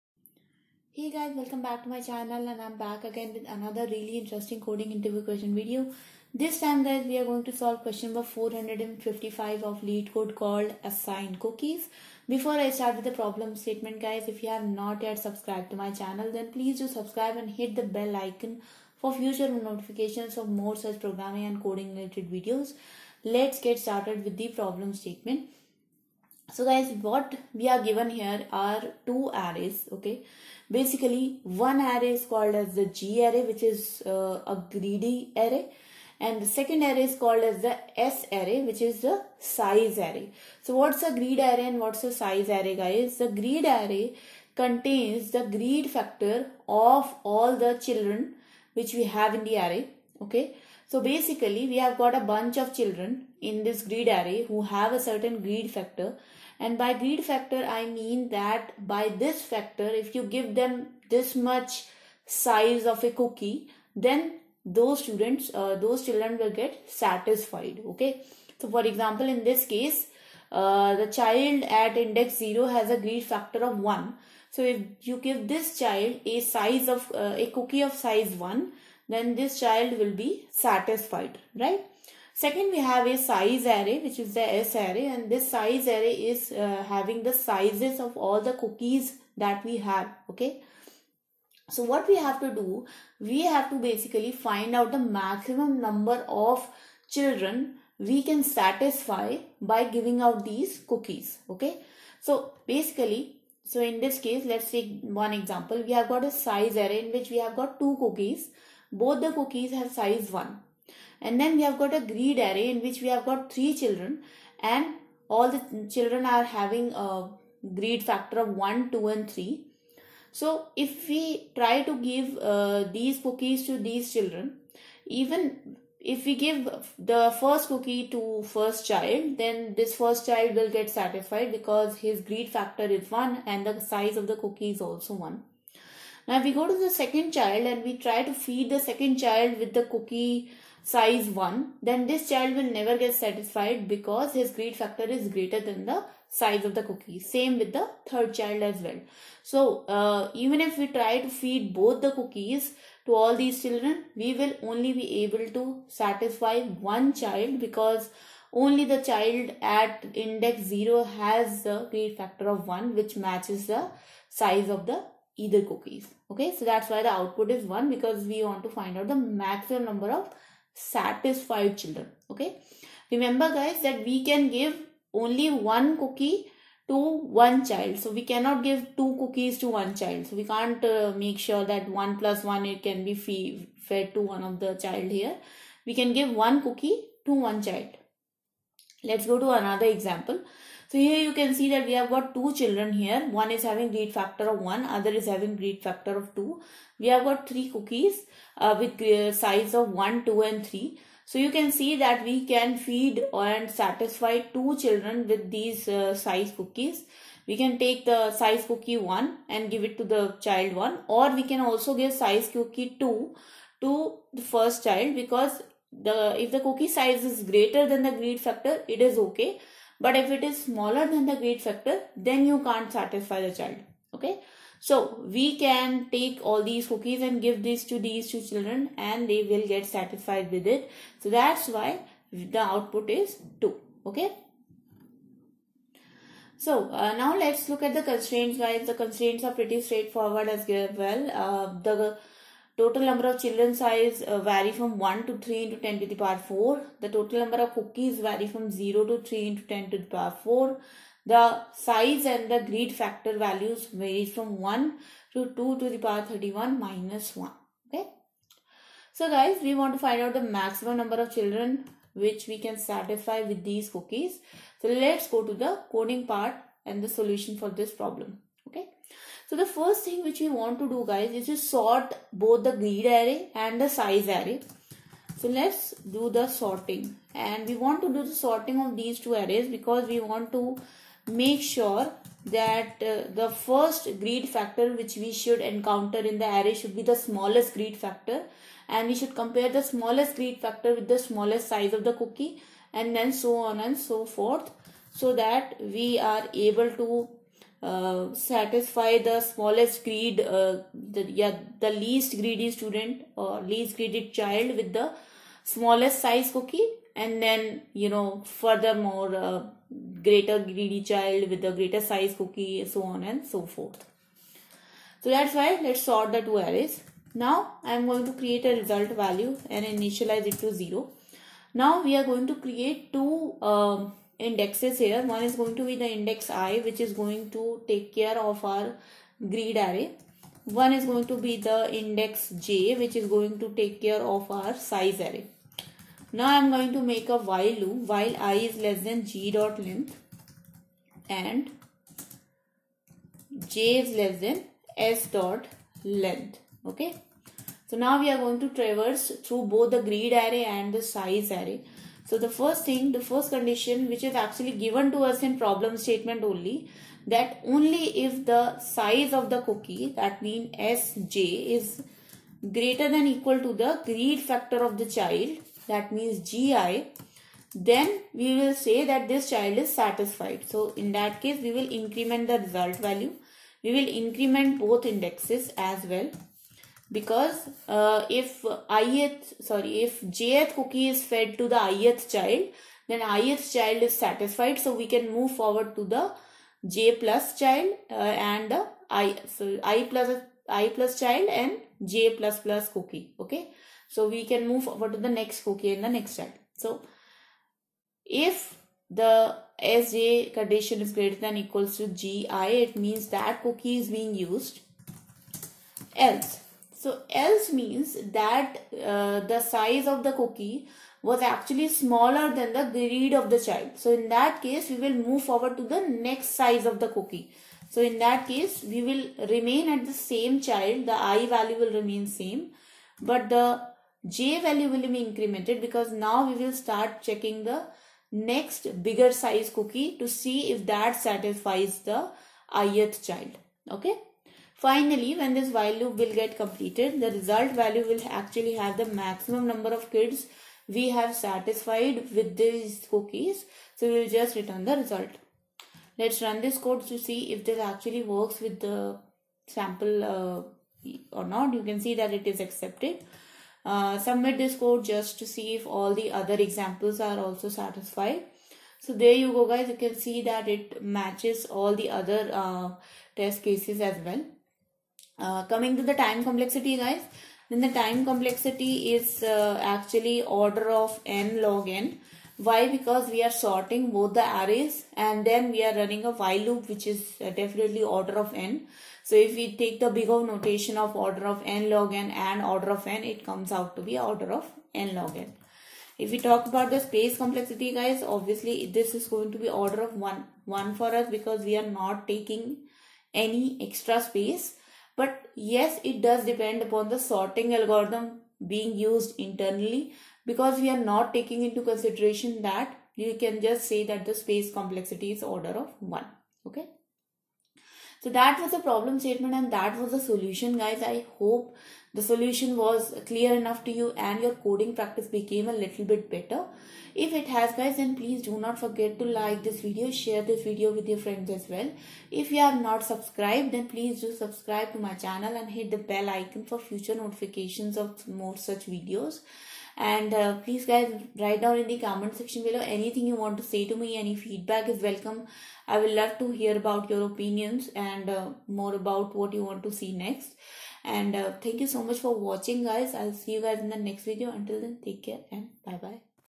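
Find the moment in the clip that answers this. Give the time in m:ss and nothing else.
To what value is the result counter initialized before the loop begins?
5:20.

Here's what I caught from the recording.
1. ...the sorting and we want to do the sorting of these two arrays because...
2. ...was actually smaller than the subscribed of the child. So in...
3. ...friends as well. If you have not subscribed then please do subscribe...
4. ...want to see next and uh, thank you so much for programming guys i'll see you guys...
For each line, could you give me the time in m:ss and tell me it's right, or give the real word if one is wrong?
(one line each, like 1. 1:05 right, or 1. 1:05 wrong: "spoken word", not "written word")
1. 4:36 right
2. 6:51 wrong: "greed", not "subscribed"
3. 8:41 right
4. 8:59 wrong: "watching", not "programming".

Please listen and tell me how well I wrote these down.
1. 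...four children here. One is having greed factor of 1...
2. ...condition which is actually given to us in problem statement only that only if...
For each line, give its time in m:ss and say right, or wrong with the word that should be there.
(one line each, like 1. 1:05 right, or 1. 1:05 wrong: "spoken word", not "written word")
1. 3:12 wrong: "two", not "four"
2. 5:53 right.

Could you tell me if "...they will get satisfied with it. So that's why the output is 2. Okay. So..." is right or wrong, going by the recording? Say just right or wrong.
right.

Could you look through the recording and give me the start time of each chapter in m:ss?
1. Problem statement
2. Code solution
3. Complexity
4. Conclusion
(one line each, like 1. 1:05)
1. 0:25
2. 4:28
3. 7:46
4. 8:33.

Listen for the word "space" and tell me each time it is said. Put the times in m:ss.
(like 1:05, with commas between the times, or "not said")
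8:06, 8:14, 8:24.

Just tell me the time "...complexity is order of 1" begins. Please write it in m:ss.
8:24.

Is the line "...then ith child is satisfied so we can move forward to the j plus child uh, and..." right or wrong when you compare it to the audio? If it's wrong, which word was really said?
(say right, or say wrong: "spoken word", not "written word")
right.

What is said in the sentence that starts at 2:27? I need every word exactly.
Same with the third child as well.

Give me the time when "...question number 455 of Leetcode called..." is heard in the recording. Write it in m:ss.
0:07.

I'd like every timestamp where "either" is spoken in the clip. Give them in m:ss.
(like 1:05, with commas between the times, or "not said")
2:45.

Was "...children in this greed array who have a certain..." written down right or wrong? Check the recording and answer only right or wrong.
right.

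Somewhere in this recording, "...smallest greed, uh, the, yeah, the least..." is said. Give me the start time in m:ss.
4:59.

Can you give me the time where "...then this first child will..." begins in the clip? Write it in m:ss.
2:09.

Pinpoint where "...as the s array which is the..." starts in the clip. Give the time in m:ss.
0:37.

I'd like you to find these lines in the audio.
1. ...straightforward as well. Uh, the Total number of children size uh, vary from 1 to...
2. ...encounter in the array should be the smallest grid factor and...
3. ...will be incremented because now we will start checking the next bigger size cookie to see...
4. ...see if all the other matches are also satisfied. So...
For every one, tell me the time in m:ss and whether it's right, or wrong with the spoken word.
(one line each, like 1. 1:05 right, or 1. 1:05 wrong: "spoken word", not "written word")
1. 3:59 right
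2. 4:45 right
3. 7:04 right
4. 7:35 wrong: "examples", not "matches".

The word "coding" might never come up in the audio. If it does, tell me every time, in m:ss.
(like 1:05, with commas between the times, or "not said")
0:04, 0:21, 4:25, 8:34.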